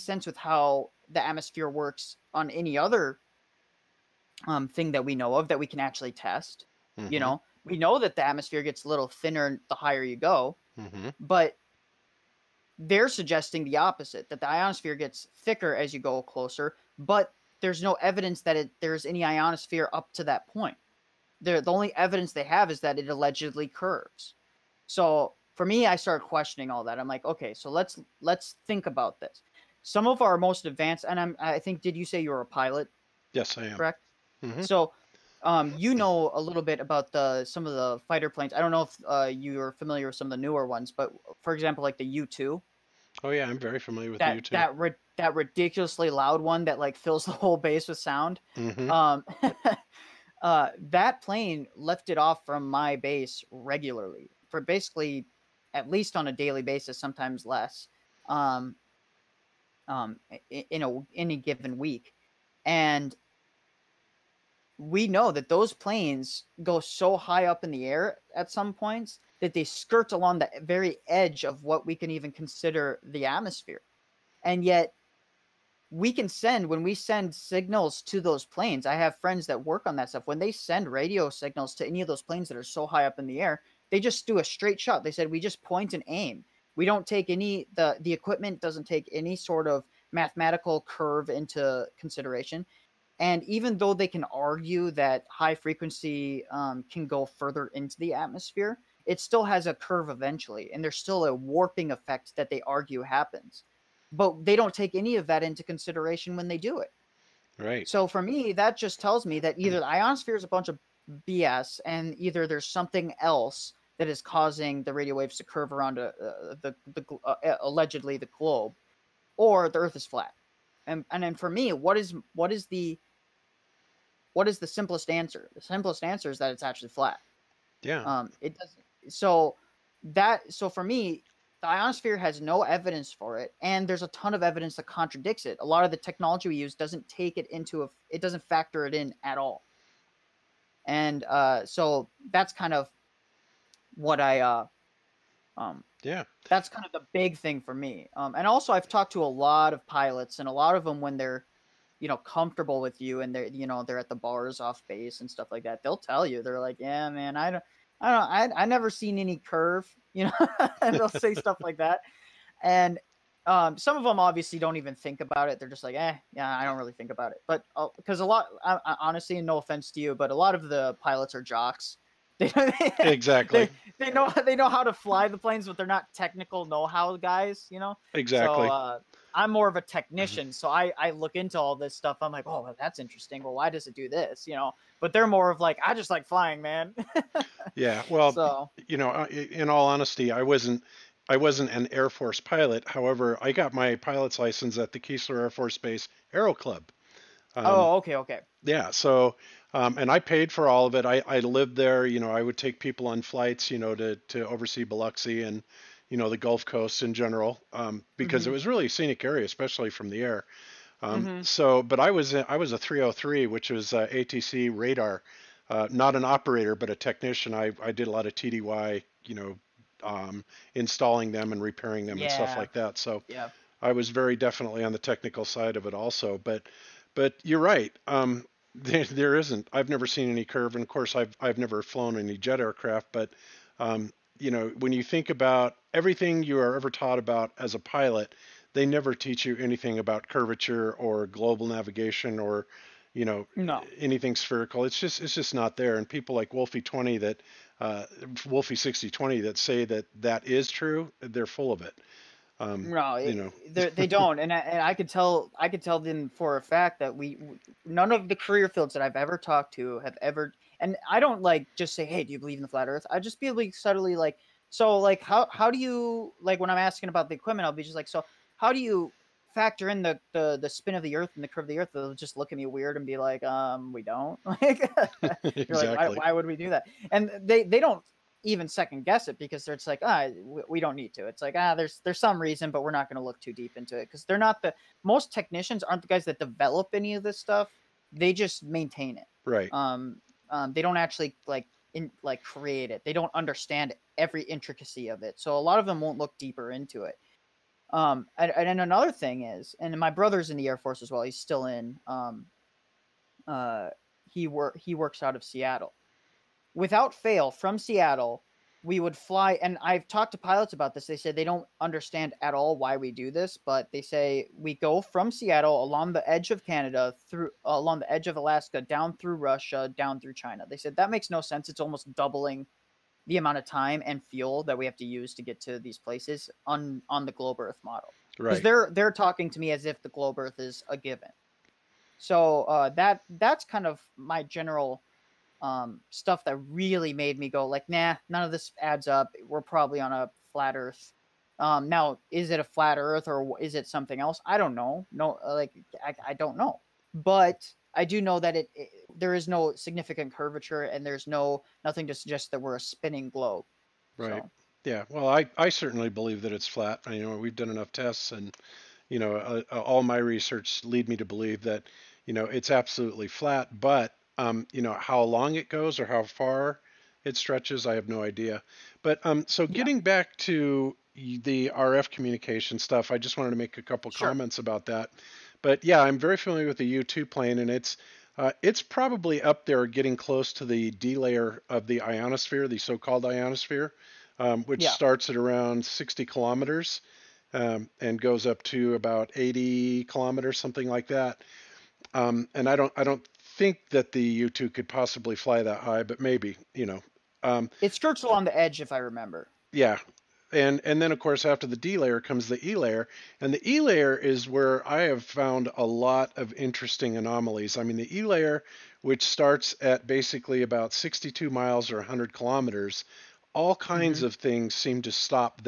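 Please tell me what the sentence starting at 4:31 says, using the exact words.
They'll just look at me weird and be like, um, we don't.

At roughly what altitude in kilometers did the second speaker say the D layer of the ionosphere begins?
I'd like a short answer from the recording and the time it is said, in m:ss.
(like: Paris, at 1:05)
60 kilometers, at 6:25.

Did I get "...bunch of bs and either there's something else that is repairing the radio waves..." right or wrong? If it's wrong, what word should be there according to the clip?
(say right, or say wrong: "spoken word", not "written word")
wrong: "causing", not "repairing".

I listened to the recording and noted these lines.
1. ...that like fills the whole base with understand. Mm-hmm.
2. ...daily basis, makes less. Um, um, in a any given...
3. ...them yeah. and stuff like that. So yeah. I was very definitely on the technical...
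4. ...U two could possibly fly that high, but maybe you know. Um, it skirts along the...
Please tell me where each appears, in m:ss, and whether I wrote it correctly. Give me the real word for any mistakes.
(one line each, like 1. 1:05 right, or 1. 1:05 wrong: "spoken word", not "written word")
1. 0:46 wrong: "sound", not "understand"
2. 0:56 wrong: "sometimes", not "makes"
3. 3:42 right
4. 6:34 right.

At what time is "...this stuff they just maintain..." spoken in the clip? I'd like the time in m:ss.
4:47.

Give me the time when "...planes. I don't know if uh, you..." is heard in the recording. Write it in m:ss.
0:38.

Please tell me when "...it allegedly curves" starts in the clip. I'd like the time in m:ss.
0:22.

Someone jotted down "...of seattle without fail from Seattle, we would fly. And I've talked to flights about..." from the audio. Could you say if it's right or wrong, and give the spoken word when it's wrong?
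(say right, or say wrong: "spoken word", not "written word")
wrong: "pilots", not "flights".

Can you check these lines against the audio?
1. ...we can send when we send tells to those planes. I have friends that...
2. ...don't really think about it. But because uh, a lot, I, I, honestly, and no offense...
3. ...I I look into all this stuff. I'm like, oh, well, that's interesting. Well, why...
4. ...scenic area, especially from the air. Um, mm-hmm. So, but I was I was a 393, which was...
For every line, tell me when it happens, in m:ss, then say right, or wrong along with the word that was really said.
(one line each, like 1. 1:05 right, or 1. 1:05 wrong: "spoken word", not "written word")
1. 1:15 wrong: "signals", not "tells"
2. 2:46 right
3. 3:00 right
4. 3:28 wrong: "303", not "393".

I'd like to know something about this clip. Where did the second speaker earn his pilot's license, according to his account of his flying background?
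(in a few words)
Keesler Air Force Base Aero Club.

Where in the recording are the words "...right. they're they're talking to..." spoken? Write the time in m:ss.
5:28.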